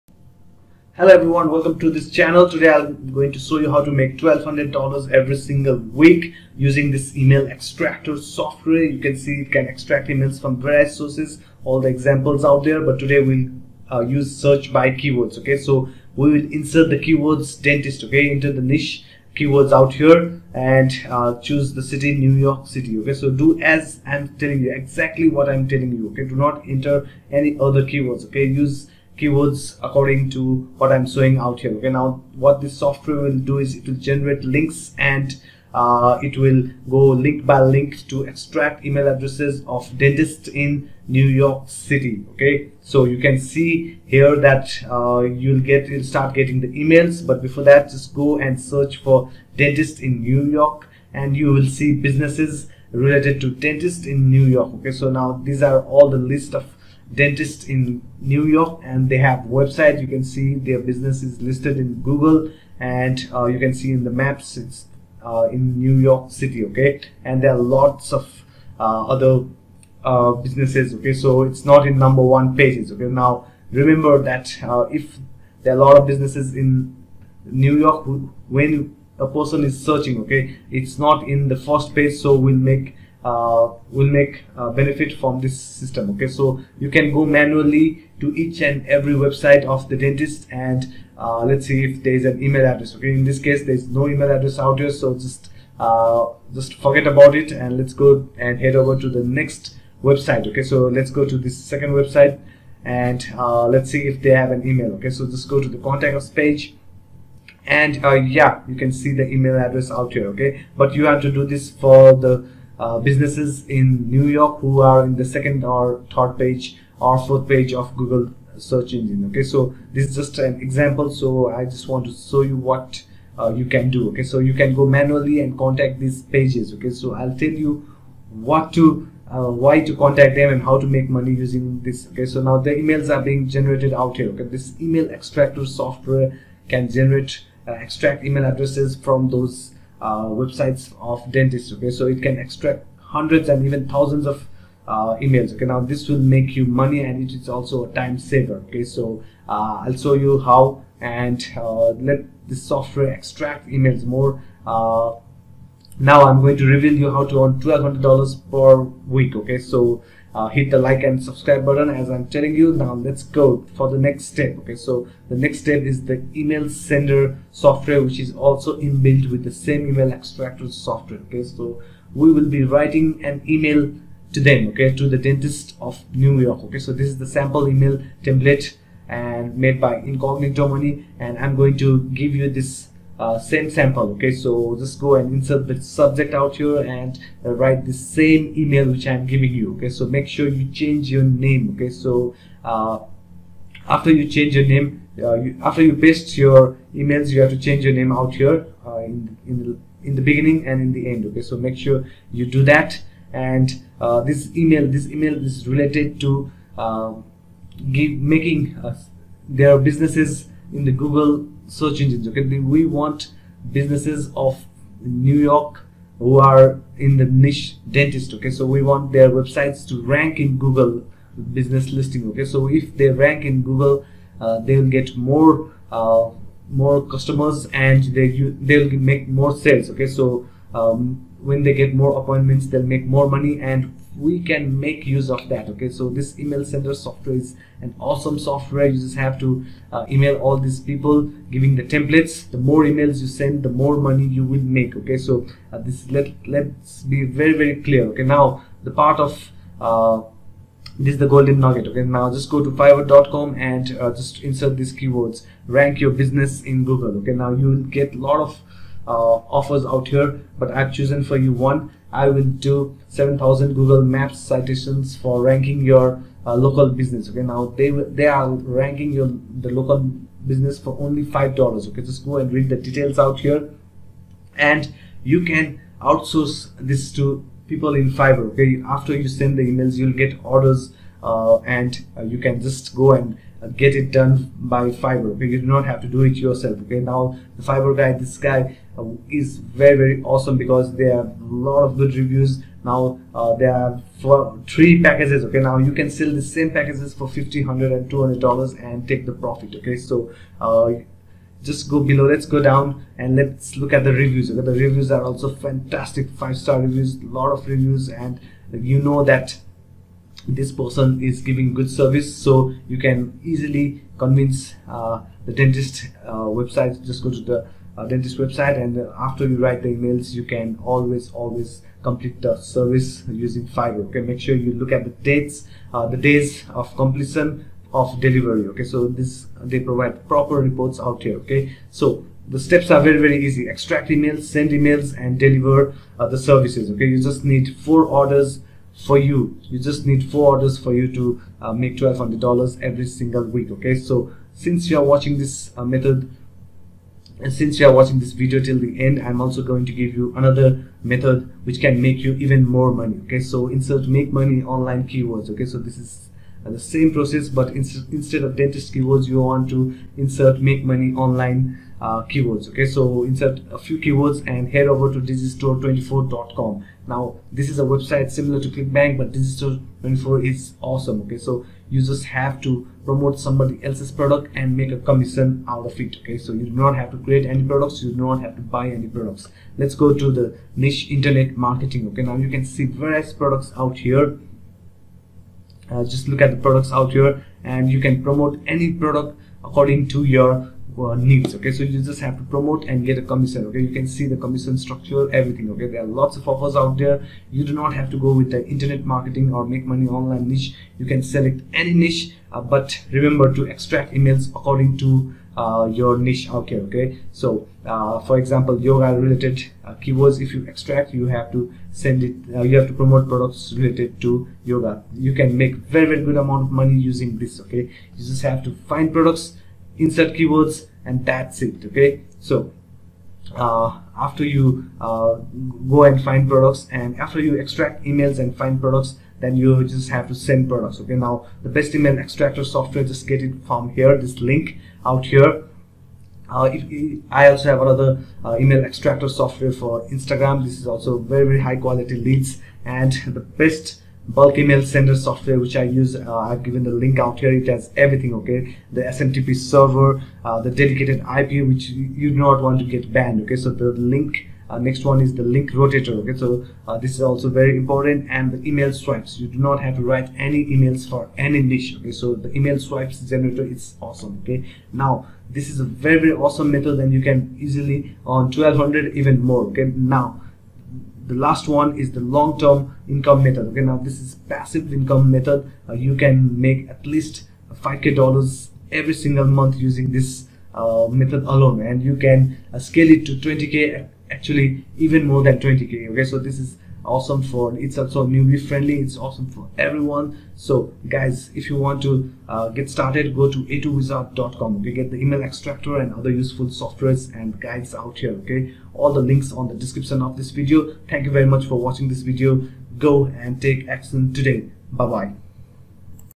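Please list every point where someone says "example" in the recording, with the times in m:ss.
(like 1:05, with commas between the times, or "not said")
0:11, 2:00, 6:48.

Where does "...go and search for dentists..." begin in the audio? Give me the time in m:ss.
0:48.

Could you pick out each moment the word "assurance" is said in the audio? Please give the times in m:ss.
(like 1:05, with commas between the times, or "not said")
not said.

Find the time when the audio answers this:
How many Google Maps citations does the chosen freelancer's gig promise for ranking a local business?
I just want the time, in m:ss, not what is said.
4:23.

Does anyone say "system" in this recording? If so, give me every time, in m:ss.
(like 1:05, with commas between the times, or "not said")
1:25.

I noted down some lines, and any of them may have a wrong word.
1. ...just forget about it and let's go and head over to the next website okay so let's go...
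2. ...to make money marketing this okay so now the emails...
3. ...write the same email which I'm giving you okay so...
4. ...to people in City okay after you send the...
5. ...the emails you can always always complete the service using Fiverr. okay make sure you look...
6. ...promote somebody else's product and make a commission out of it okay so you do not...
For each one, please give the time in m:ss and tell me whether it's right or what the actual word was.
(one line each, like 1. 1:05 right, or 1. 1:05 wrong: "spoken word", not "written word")
1. 1:36 right
2. 2:10 wrong: "using", not "marketing"
3. 3:07 right
4. 4:37 wrong: "Fiverr", not "City"
5. 5:19 right
6. 6:13 right.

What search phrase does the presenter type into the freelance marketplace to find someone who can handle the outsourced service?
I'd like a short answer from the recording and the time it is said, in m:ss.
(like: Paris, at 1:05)
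rank your business in google, at 4:15.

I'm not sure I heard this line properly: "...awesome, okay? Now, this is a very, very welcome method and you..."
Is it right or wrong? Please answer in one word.
wrong.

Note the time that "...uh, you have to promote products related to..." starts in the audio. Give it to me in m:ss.
6:52.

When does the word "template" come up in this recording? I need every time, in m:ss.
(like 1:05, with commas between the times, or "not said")
2:58, 4:01.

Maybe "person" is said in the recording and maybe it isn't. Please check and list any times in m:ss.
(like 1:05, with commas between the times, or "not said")
1:19, 5:10.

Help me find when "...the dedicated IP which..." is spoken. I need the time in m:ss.
7:30.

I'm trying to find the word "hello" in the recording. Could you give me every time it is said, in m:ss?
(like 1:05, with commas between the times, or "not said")
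0:01.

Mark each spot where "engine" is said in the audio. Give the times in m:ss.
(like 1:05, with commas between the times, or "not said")
1:58, 3:32.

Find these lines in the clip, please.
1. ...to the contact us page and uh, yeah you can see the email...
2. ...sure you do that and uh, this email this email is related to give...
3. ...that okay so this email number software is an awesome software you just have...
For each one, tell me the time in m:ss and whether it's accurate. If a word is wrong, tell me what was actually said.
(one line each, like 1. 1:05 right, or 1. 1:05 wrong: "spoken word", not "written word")
1. 1:45 right
2. 3:21 right
3. 3:55 wrong: "sender", not "number".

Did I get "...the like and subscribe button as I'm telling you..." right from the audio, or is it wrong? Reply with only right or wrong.
right.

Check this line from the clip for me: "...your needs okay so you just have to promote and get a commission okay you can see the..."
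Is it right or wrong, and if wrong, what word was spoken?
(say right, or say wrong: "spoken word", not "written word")
right.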